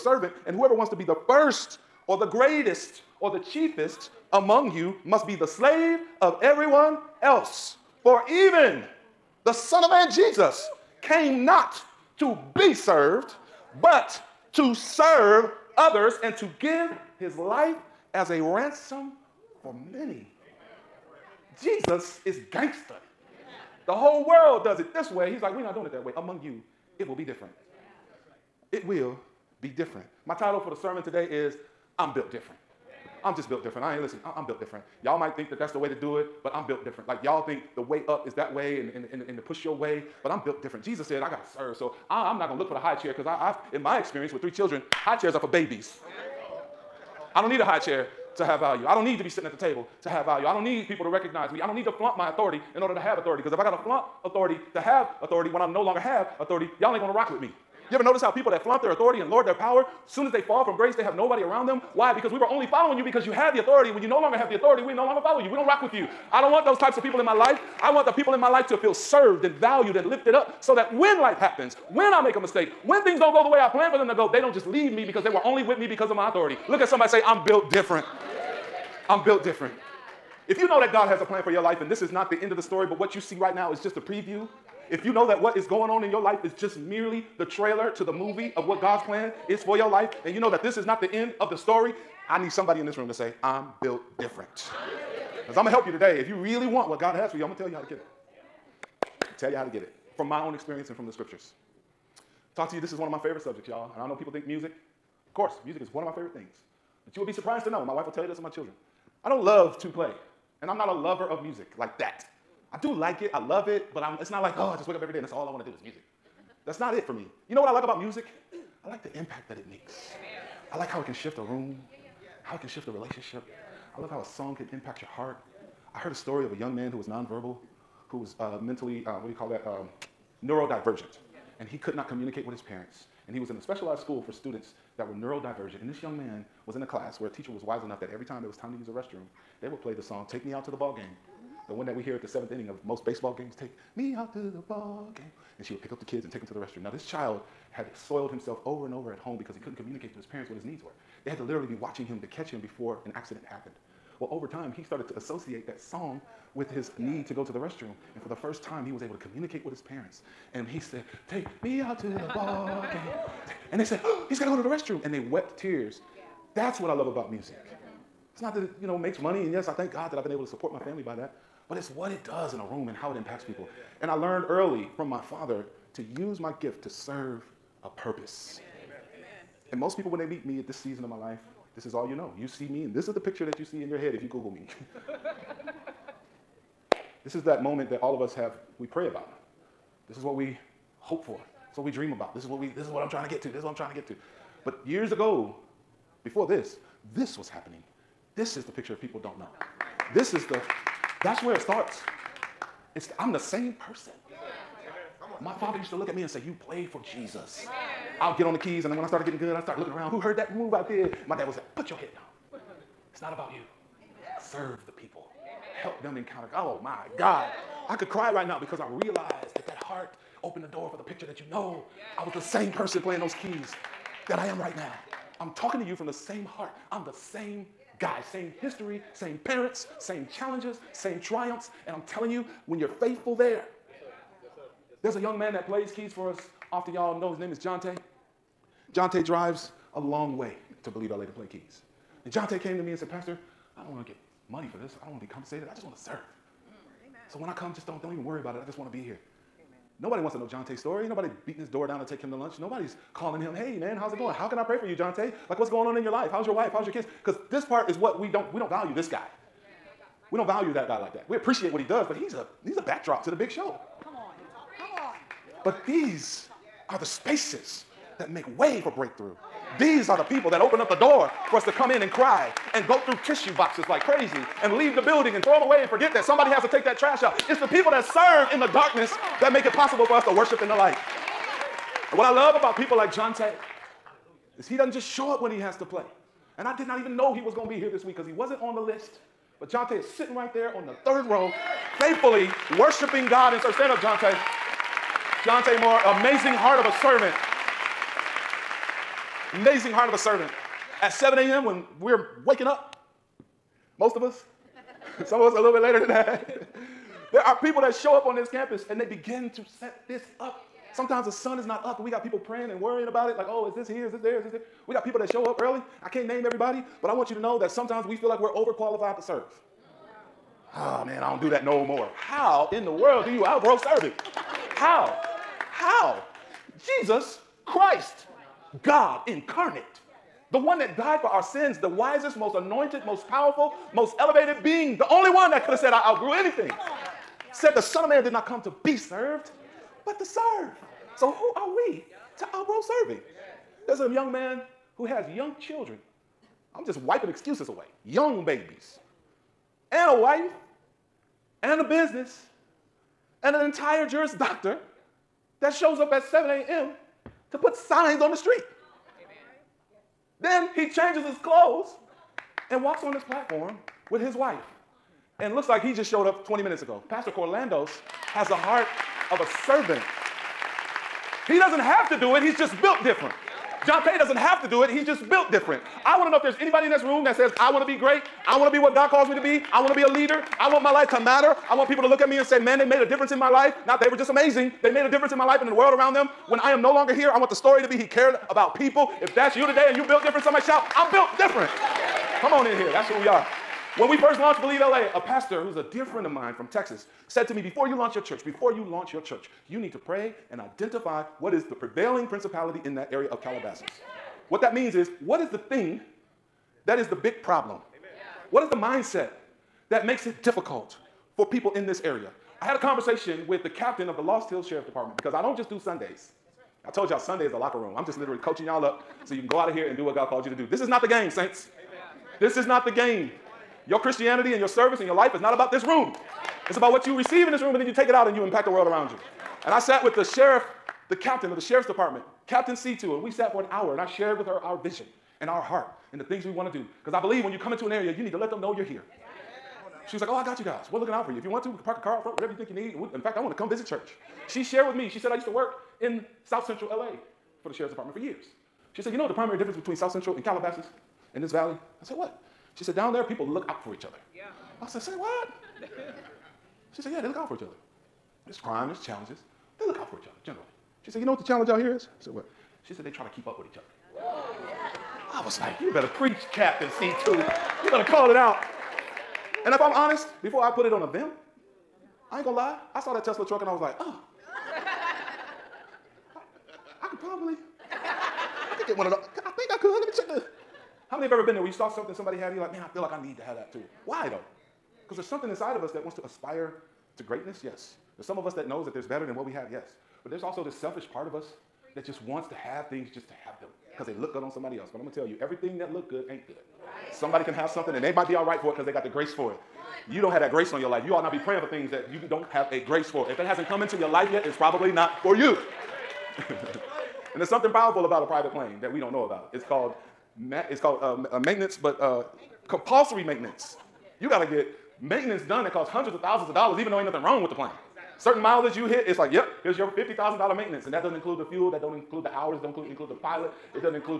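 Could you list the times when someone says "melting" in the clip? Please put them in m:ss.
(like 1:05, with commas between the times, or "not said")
not said.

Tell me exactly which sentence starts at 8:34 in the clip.
You got to get maintenance done that costs hundreds of thousands of dollars, even though ain't nothing wrong with the plane.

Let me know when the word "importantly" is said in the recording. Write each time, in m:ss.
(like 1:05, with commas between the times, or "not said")
not said.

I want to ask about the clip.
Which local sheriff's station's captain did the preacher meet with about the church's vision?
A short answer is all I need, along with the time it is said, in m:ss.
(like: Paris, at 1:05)
Lost Hills, at 6:54.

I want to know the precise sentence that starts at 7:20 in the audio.
She was like, Oh, I got you guys.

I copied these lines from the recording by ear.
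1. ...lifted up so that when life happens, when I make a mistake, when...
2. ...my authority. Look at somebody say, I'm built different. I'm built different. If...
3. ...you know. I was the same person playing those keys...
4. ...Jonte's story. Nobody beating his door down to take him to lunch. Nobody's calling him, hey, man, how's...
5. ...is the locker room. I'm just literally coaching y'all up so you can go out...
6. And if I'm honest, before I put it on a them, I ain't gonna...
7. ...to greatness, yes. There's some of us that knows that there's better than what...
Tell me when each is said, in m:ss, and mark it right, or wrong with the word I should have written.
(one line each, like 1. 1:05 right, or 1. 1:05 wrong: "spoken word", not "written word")
1. 1:10 right
2. 1:16 right
3. 3:41 right
4. 4:10 right
5. 6:57 right
6. 7:49 right
7. 8:07 right.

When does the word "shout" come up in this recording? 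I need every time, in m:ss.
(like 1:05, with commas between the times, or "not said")
6:30.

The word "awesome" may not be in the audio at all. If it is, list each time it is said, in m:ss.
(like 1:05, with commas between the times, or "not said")
not said.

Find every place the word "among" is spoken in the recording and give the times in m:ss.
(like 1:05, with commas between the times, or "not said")
0:04, 0:26.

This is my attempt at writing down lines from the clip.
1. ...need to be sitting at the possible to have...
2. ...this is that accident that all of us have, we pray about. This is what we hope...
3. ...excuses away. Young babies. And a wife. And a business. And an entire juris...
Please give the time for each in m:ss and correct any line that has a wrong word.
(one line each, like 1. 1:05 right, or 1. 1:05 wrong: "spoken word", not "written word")
1. 0:49 wrong: "table", not "possible"
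2. 3:07 wrong: "moment", not "accident"
3. 5:47 right.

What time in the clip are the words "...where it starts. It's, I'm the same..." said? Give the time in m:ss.
3:21.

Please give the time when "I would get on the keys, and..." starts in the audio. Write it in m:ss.
3:28.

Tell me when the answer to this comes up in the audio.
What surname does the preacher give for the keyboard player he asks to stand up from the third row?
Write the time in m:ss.
4:55.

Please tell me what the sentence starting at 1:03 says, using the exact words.
When you no longer have the authority, we no longer follow you.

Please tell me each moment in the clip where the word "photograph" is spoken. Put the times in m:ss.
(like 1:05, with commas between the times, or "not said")
not said.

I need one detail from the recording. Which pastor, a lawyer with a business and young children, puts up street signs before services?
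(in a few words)
Pastor Corlandos.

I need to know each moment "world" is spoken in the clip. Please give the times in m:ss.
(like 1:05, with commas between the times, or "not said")
0:24, 5:22, 6:25, 7:08.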